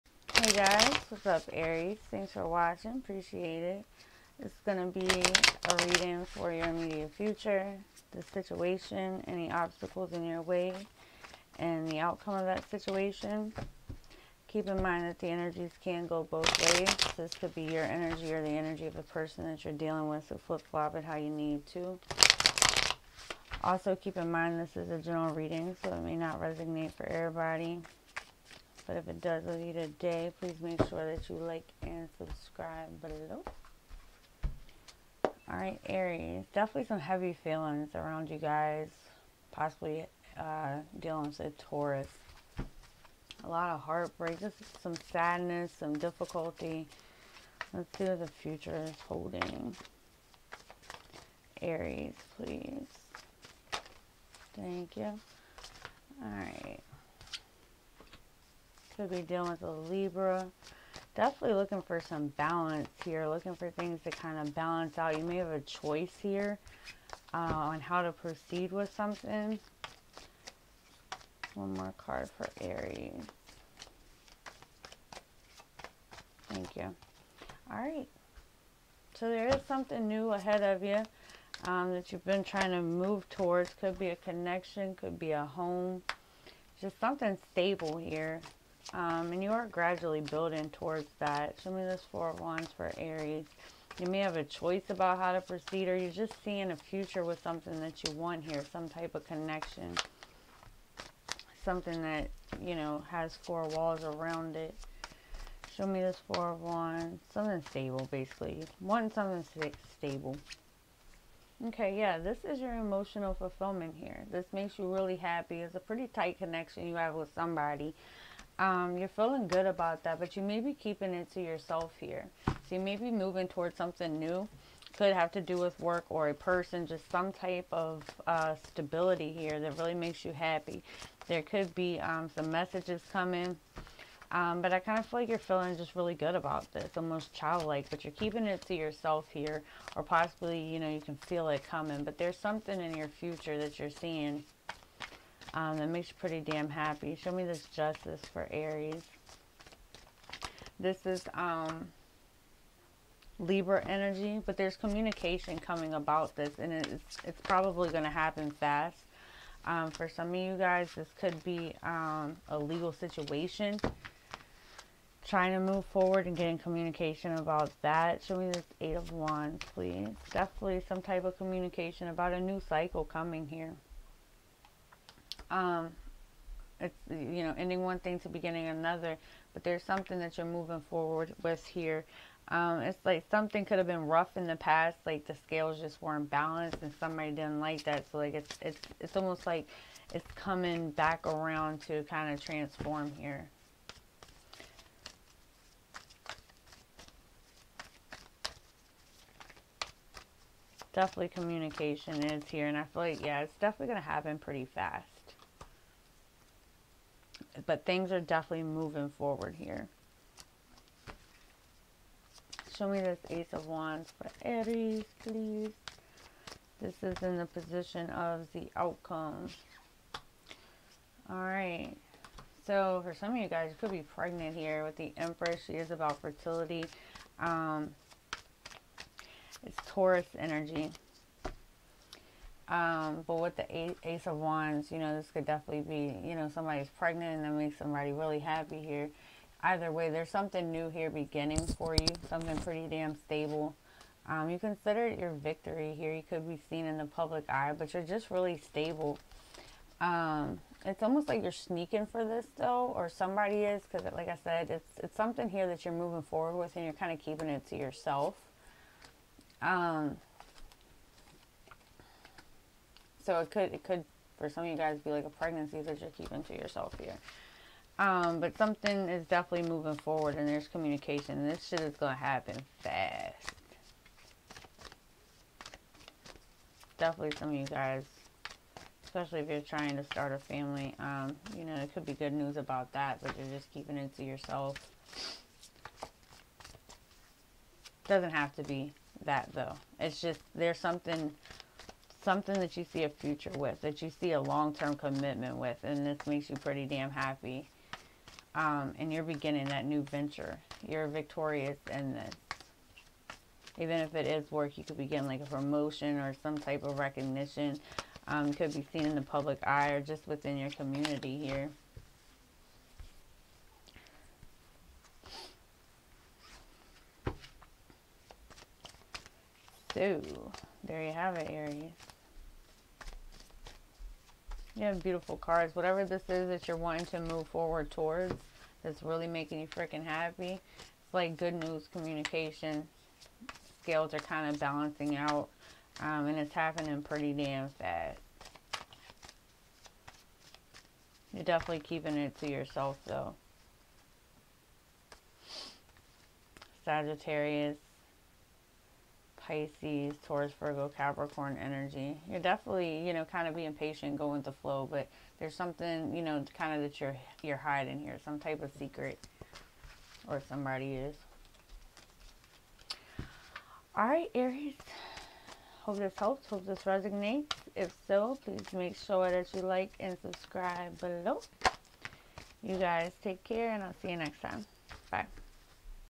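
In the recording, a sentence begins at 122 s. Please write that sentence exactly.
So you may be moving towards something new.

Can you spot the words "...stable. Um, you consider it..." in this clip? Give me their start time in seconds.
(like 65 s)
243 s.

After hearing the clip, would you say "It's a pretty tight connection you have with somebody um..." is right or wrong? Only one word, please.
right.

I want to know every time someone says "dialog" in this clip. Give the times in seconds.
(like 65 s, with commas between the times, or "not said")
not said.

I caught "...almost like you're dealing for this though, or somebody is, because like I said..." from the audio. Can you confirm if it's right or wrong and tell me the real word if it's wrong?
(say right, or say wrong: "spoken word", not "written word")
wrong: "sneaking", not "dealing".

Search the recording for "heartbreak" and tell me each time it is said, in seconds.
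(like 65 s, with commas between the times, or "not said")
43 s.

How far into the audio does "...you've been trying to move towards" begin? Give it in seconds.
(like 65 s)
82 s.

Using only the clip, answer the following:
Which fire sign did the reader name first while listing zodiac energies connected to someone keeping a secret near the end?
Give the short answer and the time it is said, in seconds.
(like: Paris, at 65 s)
Sagittarius, at 346 s.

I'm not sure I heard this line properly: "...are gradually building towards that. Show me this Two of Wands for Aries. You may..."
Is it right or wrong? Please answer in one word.
wrong.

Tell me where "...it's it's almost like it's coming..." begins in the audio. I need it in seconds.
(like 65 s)
188 s.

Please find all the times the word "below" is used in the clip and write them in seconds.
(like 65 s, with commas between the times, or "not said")
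33 s, 370 s.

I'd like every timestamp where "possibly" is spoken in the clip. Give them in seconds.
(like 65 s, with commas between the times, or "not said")
39 s, 140 s.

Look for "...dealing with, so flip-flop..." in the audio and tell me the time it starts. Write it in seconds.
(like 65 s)
19 s.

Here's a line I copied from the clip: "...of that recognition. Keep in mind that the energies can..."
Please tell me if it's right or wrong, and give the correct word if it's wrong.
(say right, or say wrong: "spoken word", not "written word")
wrong: "situation", not "recognition".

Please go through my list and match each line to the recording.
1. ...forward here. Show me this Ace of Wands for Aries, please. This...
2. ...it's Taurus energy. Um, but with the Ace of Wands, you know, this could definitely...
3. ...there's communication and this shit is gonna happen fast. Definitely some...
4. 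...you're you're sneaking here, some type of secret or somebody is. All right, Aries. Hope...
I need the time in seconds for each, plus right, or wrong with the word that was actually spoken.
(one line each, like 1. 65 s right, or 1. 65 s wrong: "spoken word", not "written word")
1. 209 s right
2. 229 s right
3. 270 s right
4. 357 s wrong: "hiding", not "sneaking".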